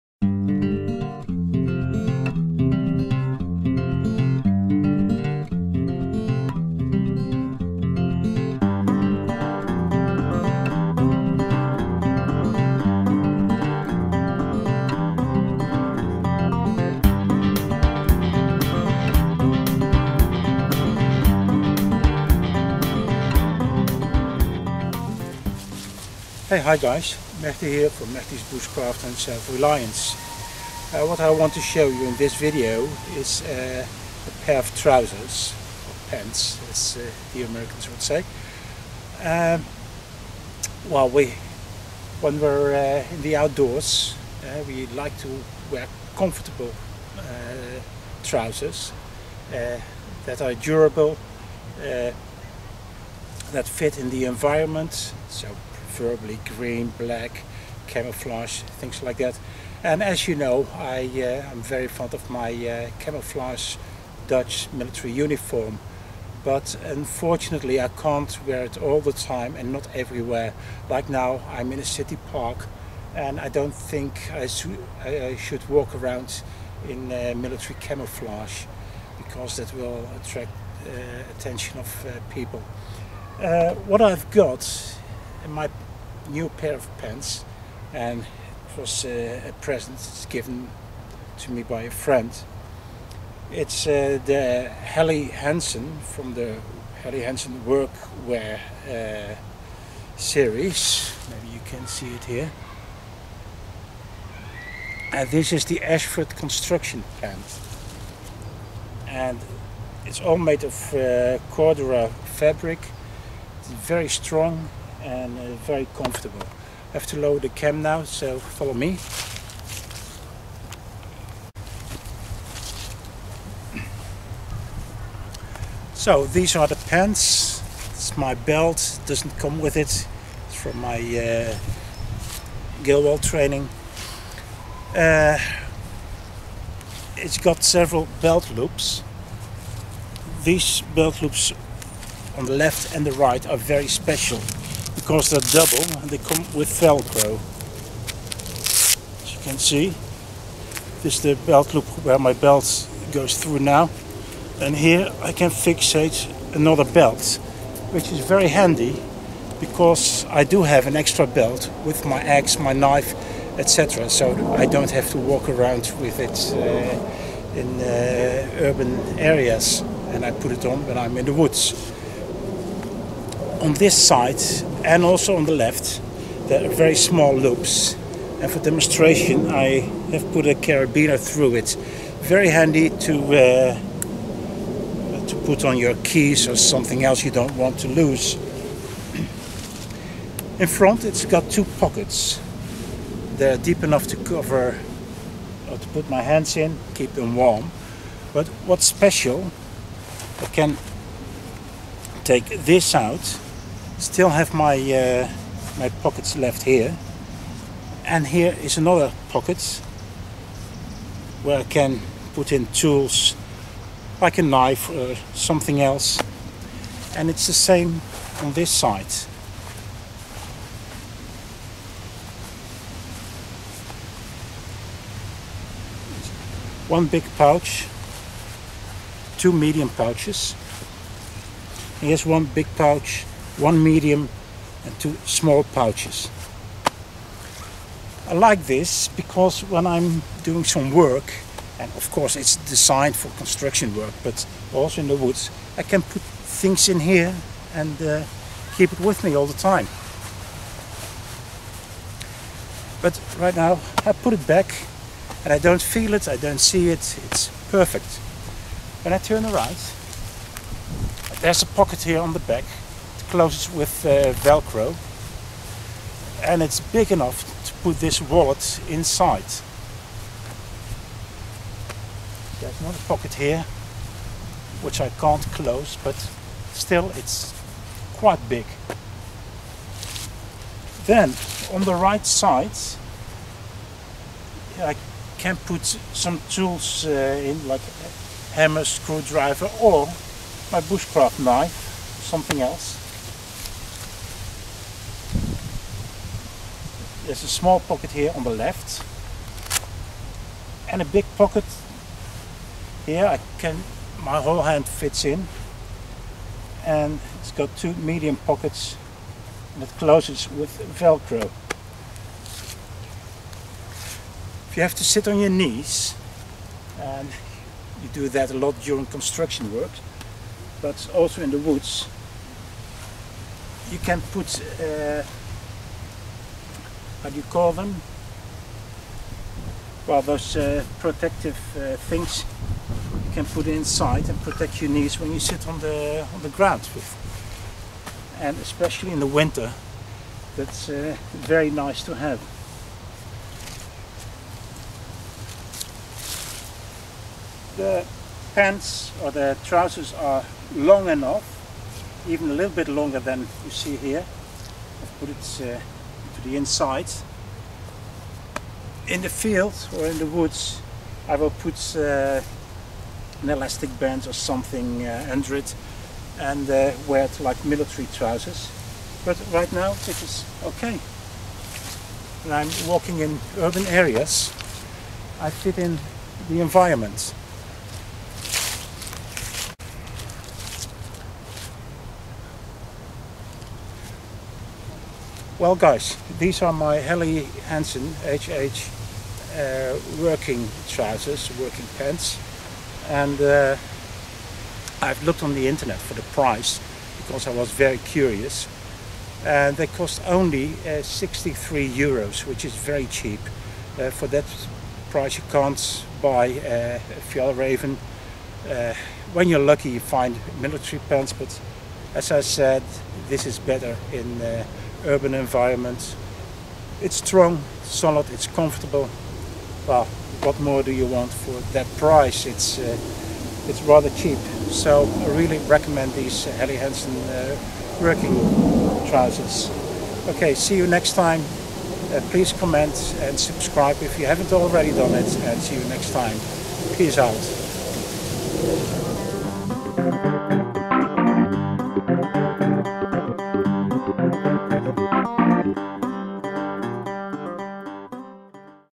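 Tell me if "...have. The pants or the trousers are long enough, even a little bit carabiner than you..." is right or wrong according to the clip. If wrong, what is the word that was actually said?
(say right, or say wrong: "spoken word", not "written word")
wrong: "longer", not "carabiner".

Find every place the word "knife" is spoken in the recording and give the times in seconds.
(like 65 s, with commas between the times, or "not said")
162 s, 214 s, 291 s.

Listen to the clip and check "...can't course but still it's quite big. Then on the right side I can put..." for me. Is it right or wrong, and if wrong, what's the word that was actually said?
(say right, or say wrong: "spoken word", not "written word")
wrong: "close", not "course".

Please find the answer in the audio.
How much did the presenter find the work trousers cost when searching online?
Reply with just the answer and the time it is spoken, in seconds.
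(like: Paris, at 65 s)
63 euros, at 401 s.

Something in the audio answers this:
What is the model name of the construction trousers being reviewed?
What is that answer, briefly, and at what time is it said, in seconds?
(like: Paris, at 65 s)
Ashford, at 105 s.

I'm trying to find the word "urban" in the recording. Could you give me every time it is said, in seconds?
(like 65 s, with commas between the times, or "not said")
168 s, 373 s, 415 s.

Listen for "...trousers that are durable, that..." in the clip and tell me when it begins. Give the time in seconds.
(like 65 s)
48 s.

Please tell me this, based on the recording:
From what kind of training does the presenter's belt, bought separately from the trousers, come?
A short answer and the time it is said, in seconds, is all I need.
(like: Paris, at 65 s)
Gilwell training, at 132 s.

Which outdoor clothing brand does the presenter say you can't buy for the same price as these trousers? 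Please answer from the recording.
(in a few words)
Fjallraven.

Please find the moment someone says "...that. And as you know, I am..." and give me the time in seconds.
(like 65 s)
59 s.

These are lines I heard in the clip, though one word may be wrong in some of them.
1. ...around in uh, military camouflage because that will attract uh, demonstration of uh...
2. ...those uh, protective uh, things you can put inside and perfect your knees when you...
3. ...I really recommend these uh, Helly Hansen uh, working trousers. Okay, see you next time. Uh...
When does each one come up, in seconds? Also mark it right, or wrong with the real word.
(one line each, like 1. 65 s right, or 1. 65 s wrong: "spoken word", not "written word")
1. 75 s wrong: "attention", not "demonstration"
2. 330 s wrong: "protect", not "perfect"
3. 425 s right.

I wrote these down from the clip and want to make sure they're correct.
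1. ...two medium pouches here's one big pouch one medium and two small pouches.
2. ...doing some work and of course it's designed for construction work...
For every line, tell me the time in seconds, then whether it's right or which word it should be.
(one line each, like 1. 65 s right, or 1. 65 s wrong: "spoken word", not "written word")
1. 229 s right
2. 240 s right.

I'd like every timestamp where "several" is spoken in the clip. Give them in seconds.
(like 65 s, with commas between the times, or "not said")
137 s.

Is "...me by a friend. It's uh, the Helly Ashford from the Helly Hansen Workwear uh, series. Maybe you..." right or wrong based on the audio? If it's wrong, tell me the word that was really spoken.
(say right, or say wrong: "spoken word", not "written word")
wrong: "Hansen", not "Ashford".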